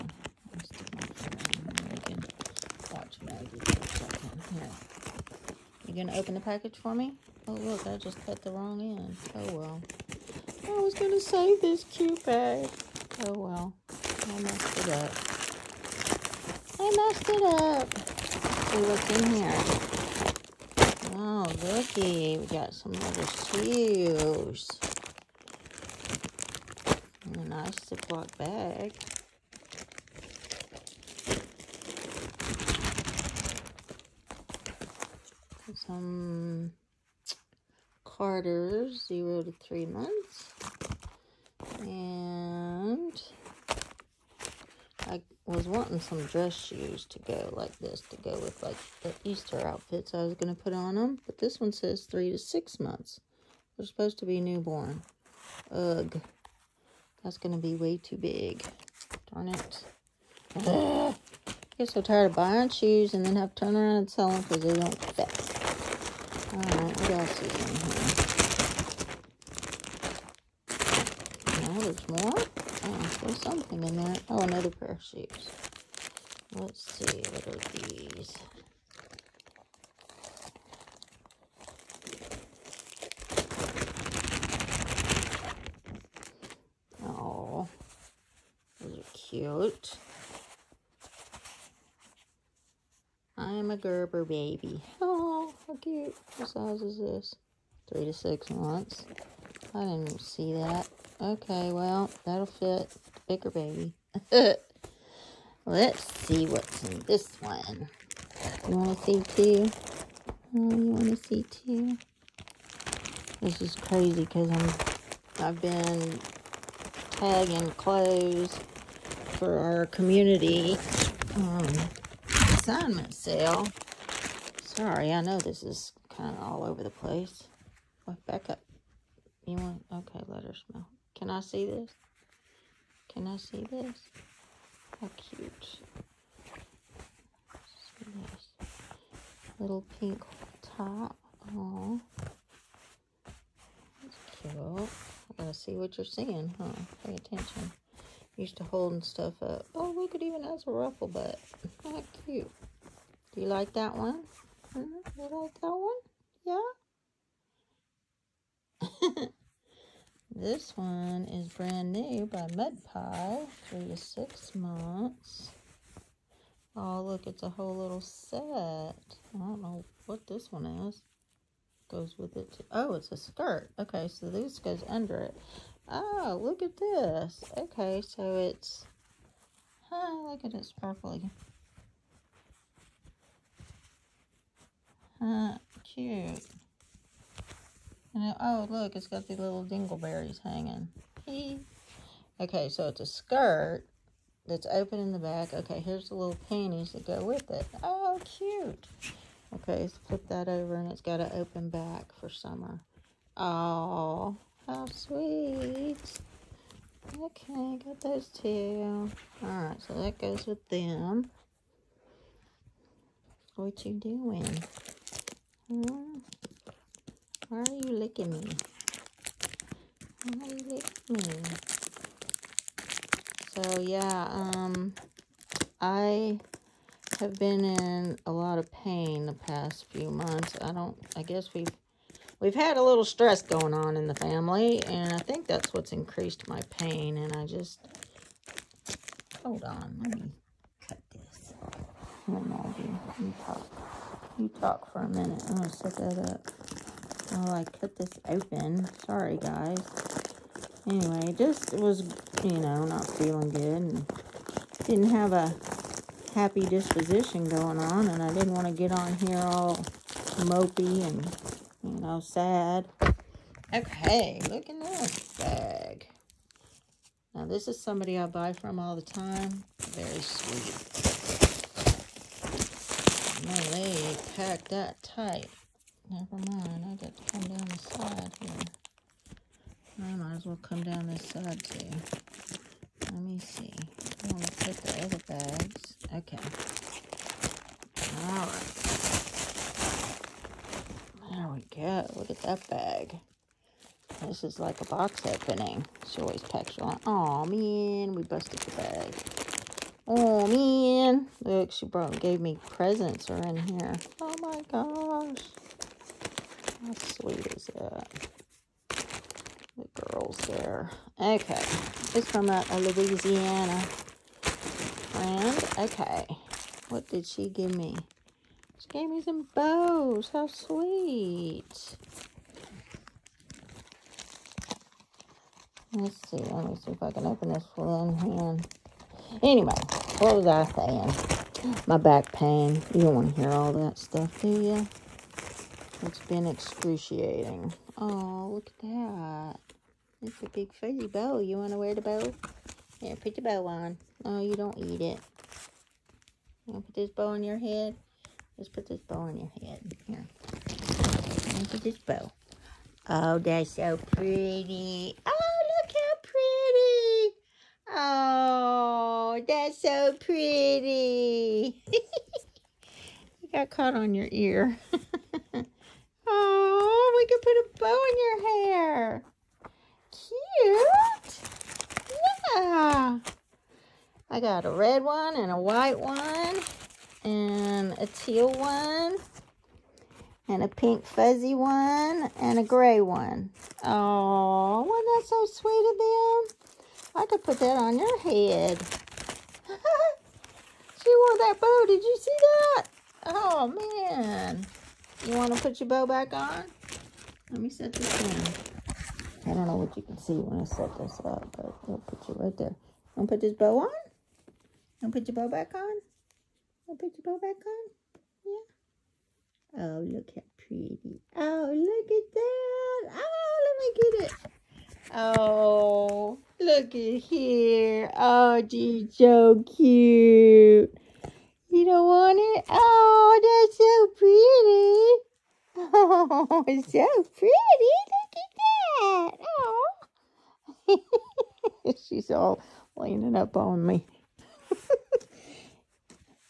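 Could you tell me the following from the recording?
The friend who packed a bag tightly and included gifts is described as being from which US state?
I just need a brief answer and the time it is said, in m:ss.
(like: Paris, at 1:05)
Louisiana, at 5:12.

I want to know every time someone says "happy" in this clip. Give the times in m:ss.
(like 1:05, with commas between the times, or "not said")
4:16.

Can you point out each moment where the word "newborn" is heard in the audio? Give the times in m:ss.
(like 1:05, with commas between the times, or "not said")
0:54.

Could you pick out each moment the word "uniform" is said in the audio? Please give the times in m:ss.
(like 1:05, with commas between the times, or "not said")
not said.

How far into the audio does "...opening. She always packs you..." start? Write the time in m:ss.
4:55.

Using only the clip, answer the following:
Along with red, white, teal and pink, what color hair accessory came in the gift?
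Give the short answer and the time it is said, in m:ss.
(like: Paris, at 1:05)
gray, at 6:22.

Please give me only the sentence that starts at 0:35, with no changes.
some Carter's, zero to three months.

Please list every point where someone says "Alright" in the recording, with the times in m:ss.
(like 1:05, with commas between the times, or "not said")
1:06, 3:29, 4:48.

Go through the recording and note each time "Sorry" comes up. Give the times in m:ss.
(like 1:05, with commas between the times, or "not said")
2:04, 4:09.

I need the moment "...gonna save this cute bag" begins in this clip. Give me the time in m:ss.
0:10.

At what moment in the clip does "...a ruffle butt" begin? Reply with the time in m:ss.
2:30.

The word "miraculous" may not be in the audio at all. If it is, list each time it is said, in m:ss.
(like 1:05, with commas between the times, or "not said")
not said.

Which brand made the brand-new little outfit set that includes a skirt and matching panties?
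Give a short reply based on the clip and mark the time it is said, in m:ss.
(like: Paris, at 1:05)
Mud Pie, at 2:42.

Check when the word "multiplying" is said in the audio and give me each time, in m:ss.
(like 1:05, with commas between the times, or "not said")
not said.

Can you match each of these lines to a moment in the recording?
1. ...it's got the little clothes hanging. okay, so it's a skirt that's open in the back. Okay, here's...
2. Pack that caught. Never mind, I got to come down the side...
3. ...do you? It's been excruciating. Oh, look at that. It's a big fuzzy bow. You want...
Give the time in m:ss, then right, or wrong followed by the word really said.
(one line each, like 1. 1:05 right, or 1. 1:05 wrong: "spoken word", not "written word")
1. 3:08 wrong: "dingleberries", not "clothes"
2. 4:34 wrong: "tight", not "caught"
3. 5:34 right.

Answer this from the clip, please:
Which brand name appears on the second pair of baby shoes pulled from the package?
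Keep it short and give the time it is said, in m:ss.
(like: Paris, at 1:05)
Gerber, at 1:33.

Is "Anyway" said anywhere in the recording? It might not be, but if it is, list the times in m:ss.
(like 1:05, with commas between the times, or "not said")
4:10, 5:29.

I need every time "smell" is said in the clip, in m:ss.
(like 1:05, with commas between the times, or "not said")
2:10.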